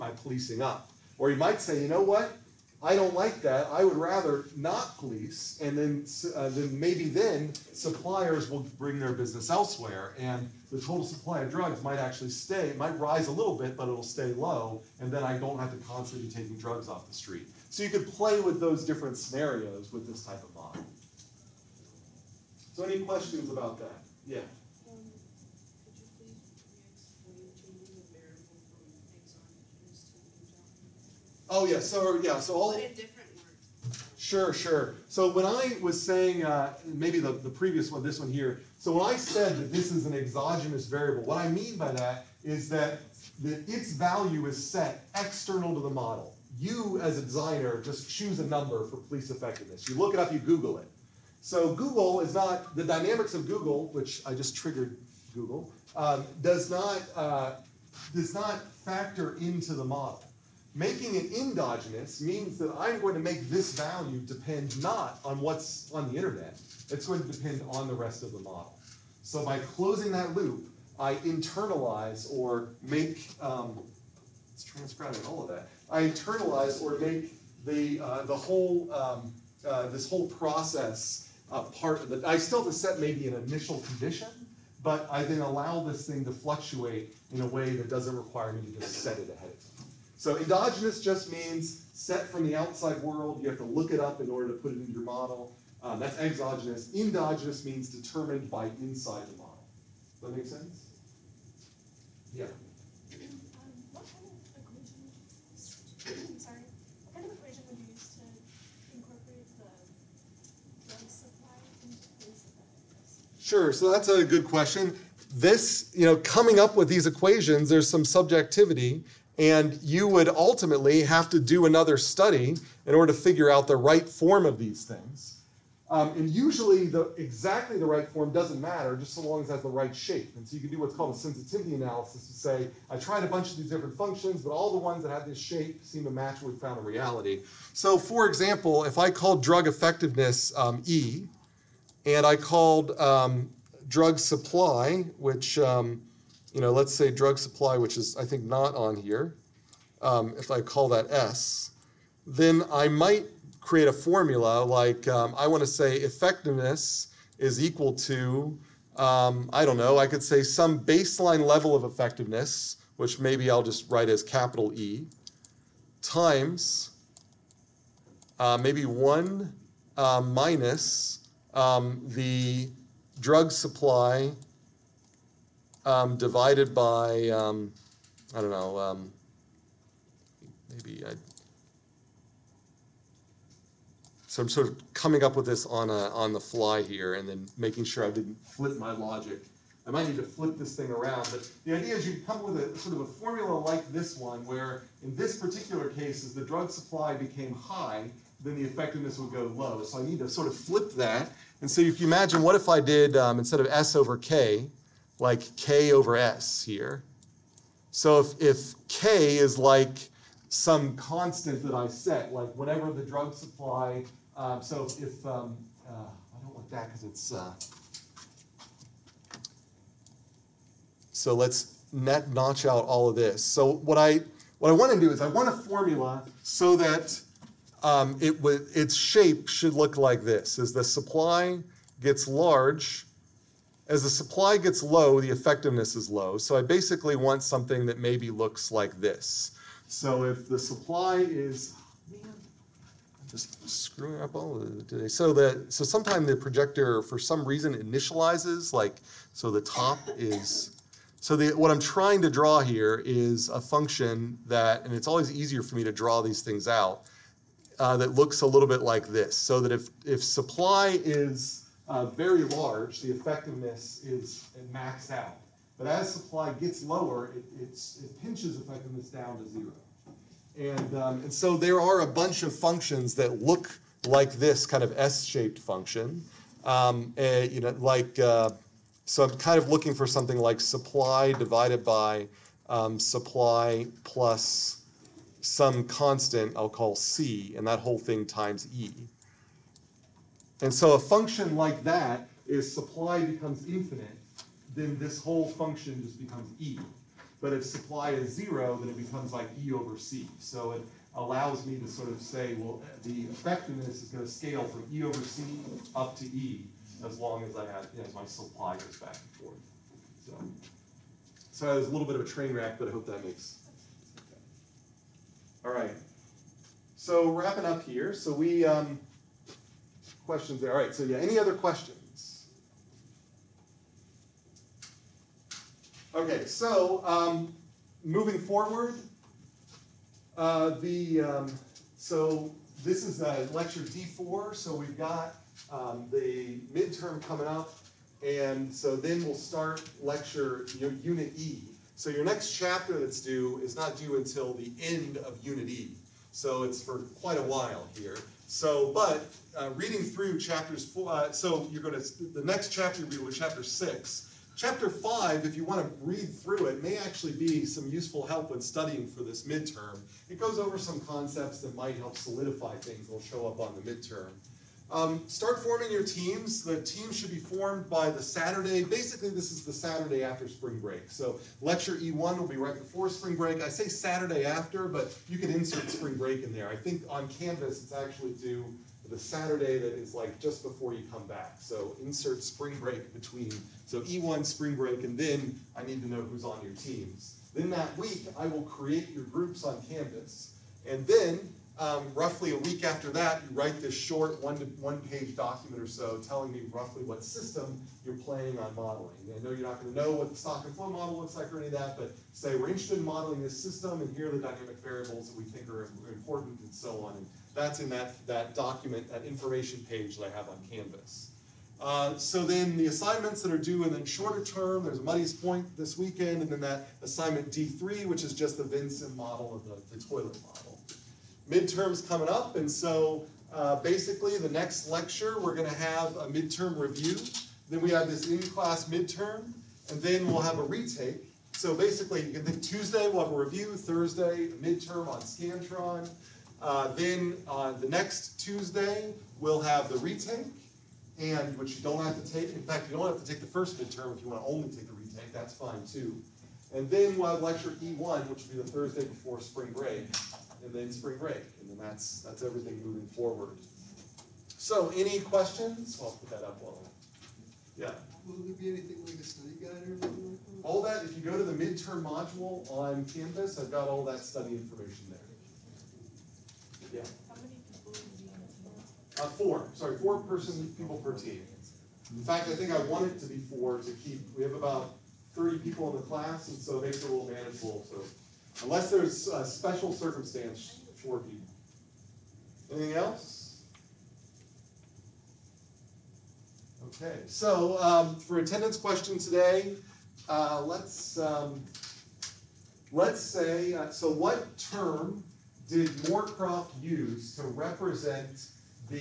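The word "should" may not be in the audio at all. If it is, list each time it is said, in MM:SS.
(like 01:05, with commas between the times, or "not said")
03:49, 06:07.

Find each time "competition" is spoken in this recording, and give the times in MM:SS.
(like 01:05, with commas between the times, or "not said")
not said.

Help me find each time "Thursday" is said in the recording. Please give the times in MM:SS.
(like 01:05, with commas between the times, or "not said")
07:13, 07:28.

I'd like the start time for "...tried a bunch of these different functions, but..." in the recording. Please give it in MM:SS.
02:12.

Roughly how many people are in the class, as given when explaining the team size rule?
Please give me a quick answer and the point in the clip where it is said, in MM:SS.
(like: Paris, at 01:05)
30, at 07:55.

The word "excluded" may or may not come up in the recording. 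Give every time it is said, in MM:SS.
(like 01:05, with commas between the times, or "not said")
not said.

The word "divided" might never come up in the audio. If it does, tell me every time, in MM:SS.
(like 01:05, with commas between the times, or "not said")
02:56, 04:41.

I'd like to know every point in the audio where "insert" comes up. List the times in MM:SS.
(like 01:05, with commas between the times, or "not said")
06:15, 06:22.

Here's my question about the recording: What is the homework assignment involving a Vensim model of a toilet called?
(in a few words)
D3.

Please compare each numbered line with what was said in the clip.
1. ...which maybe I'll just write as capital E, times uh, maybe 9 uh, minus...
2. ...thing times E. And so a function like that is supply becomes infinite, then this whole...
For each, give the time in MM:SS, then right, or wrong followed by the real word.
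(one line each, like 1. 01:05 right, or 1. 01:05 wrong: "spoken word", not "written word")
1. 02:42 wrong: "1", not "9"
2. 04:47 right.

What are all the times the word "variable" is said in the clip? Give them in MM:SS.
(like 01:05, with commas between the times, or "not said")
00:40, 06:44.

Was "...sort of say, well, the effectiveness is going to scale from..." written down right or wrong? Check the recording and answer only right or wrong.
right.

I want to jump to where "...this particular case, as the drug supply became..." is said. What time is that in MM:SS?
03:15.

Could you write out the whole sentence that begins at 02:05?
Um, and usually, the, exactly the right form doesn't matter, just so long as it has the right shape.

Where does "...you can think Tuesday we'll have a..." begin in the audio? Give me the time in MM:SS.
07:12.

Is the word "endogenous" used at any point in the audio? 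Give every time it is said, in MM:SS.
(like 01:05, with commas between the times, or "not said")
01:01, 01:30, 01:36.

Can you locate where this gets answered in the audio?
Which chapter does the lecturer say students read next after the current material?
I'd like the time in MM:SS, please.
05:53.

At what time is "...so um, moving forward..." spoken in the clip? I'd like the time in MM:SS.
05:26.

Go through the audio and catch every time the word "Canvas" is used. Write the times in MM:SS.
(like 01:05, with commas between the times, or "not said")
06:17, 06:29, 06:50, 07:43.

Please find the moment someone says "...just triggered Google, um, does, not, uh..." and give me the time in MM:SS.
00:54.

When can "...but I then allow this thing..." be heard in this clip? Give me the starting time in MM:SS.
01:24.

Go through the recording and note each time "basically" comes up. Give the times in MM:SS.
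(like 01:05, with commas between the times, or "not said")
03:56, 06:08, 07:03, 07:11.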